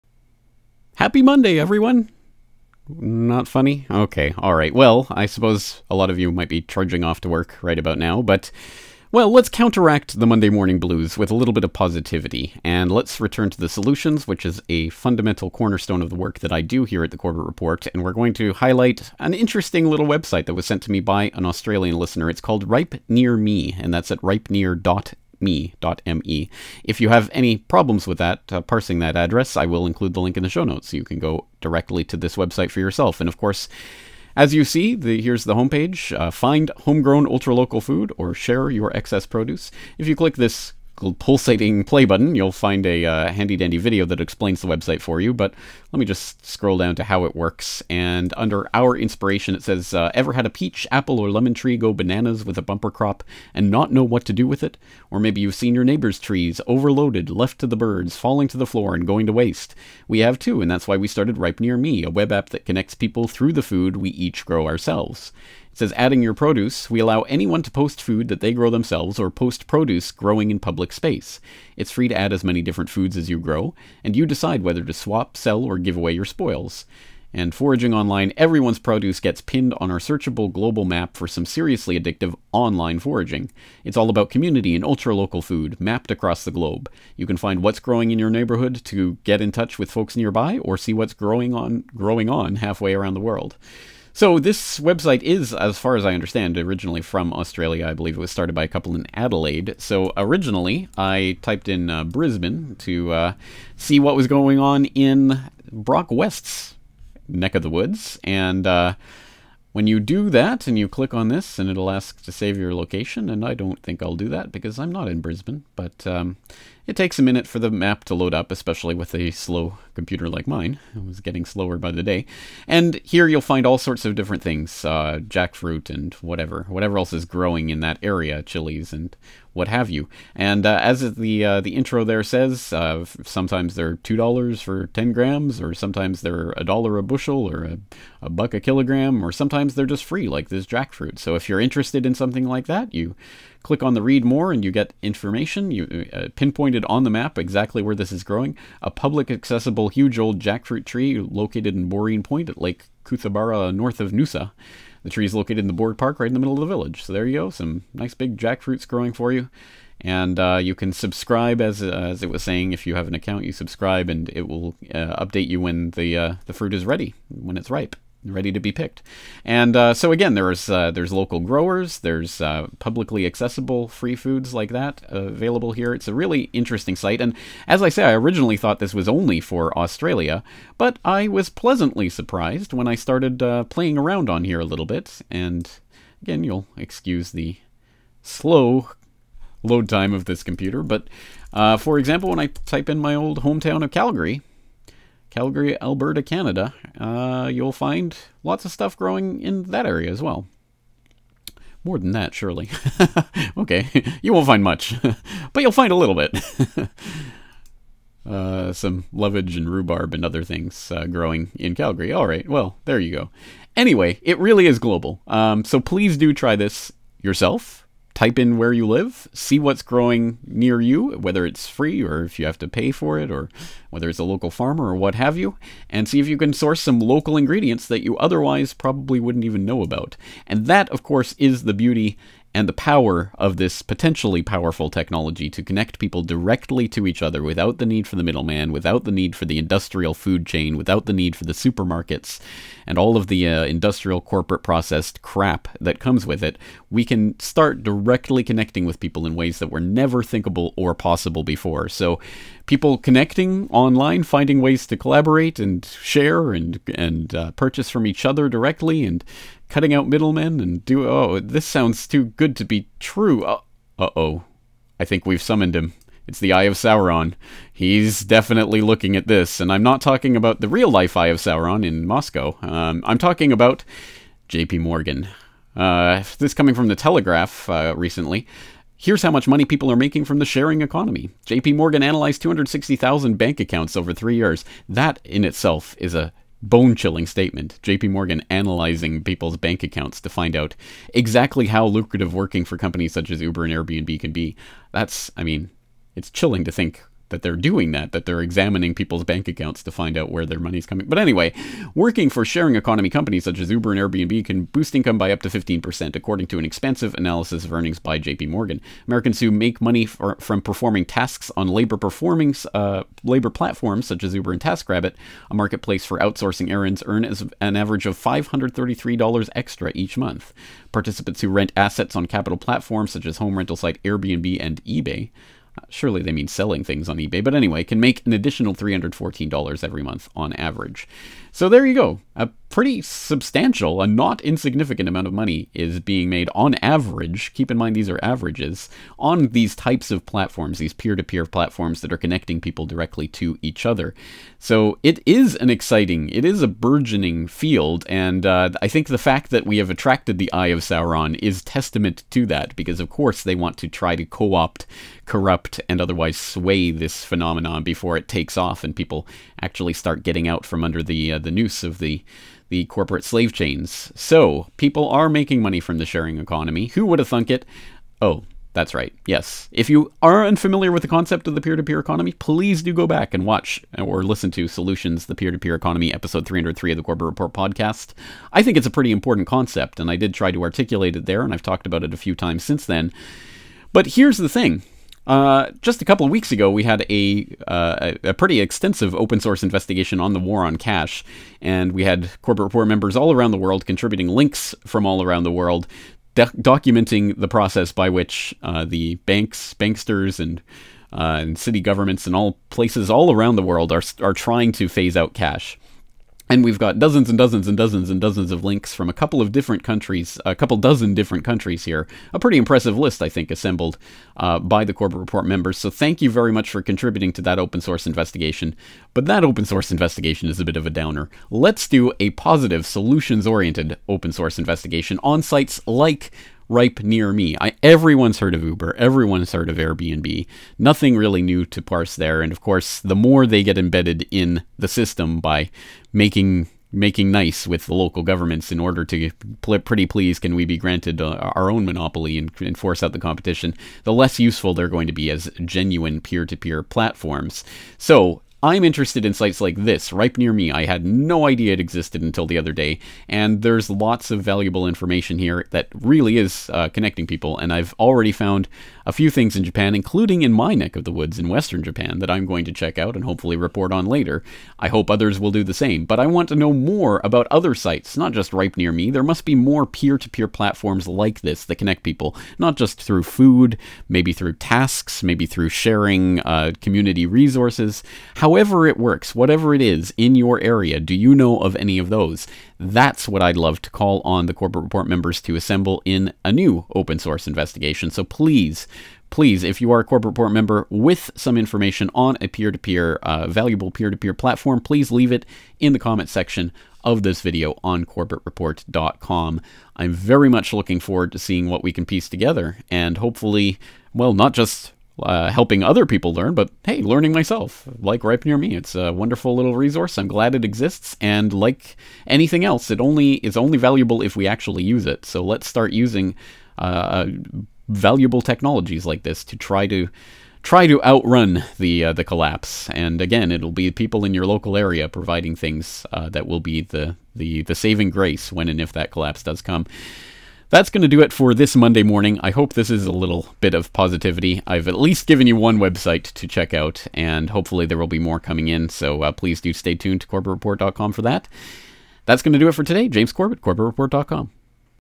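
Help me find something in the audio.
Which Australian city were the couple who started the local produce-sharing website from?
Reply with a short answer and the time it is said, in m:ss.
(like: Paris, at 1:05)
Adelaide, at 1:39.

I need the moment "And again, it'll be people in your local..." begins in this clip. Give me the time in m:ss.
8:42.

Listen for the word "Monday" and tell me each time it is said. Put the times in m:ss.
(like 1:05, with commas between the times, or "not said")
0:01, 0:10, 8:51.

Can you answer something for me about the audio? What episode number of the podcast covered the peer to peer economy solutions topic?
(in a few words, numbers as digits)
303.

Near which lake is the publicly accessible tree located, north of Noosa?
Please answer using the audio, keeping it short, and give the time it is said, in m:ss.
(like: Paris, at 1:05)
Lake Cootharaba, at 2:32.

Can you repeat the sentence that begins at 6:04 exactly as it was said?
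So, people are making money from the sharing economy.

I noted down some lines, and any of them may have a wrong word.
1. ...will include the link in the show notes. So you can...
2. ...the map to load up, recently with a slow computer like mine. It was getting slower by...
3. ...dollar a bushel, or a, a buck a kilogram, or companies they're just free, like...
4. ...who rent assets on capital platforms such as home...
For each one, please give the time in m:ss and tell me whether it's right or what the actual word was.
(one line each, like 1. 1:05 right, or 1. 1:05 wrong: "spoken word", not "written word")
1. 0:29 right
2. 1:57 wrong: "especially", not "recently"
3. 2:16 wrong: "sometimes", not "companies"
4. 5:21 right.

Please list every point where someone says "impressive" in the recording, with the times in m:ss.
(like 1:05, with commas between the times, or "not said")
6:52.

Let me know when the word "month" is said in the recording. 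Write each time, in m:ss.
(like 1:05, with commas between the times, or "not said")
5:20, 5:30.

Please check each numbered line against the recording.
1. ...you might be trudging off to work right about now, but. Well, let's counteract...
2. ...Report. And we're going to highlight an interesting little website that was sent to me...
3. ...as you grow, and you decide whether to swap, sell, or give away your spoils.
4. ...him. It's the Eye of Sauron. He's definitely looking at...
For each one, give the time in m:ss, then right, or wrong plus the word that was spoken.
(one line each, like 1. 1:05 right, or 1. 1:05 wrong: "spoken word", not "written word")
1. 0:06 right
2. 0:17 right
3. 1:13 right
4. 4:25 right.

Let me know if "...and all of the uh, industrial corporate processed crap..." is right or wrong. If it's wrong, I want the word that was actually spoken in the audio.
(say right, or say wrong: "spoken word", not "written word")
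right.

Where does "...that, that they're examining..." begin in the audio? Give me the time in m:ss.
4:57.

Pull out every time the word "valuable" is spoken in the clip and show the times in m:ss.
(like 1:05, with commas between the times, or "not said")
7:34, 8:13, 8:33, 8:37.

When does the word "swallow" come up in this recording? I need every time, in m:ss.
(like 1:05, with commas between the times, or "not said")
not said.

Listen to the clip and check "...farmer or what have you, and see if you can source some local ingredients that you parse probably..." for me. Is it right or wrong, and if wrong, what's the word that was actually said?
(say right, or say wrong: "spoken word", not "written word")
wrong: "otherwise", not "parse".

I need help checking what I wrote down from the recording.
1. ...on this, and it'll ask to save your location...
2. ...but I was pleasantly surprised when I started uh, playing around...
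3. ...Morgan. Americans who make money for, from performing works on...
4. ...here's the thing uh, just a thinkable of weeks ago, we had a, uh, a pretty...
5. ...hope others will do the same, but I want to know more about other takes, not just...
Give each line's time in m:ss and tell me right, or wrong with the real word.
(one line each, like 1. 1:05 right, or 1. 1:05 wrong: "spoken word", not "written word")
1. 1:51 right
2. 3:00 right
3. 5:08 wrong: "tasks", not "works"
4. 6:24 wrong: "couple", not "thinkable"
5. 7:44 wrong: "sites", not "takes".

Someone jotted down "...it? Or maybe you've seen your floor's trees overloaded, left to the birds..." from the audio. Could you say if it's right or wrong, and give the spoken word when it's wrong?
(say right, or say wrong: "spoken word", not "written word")
wrong: "neighbor", not "floor".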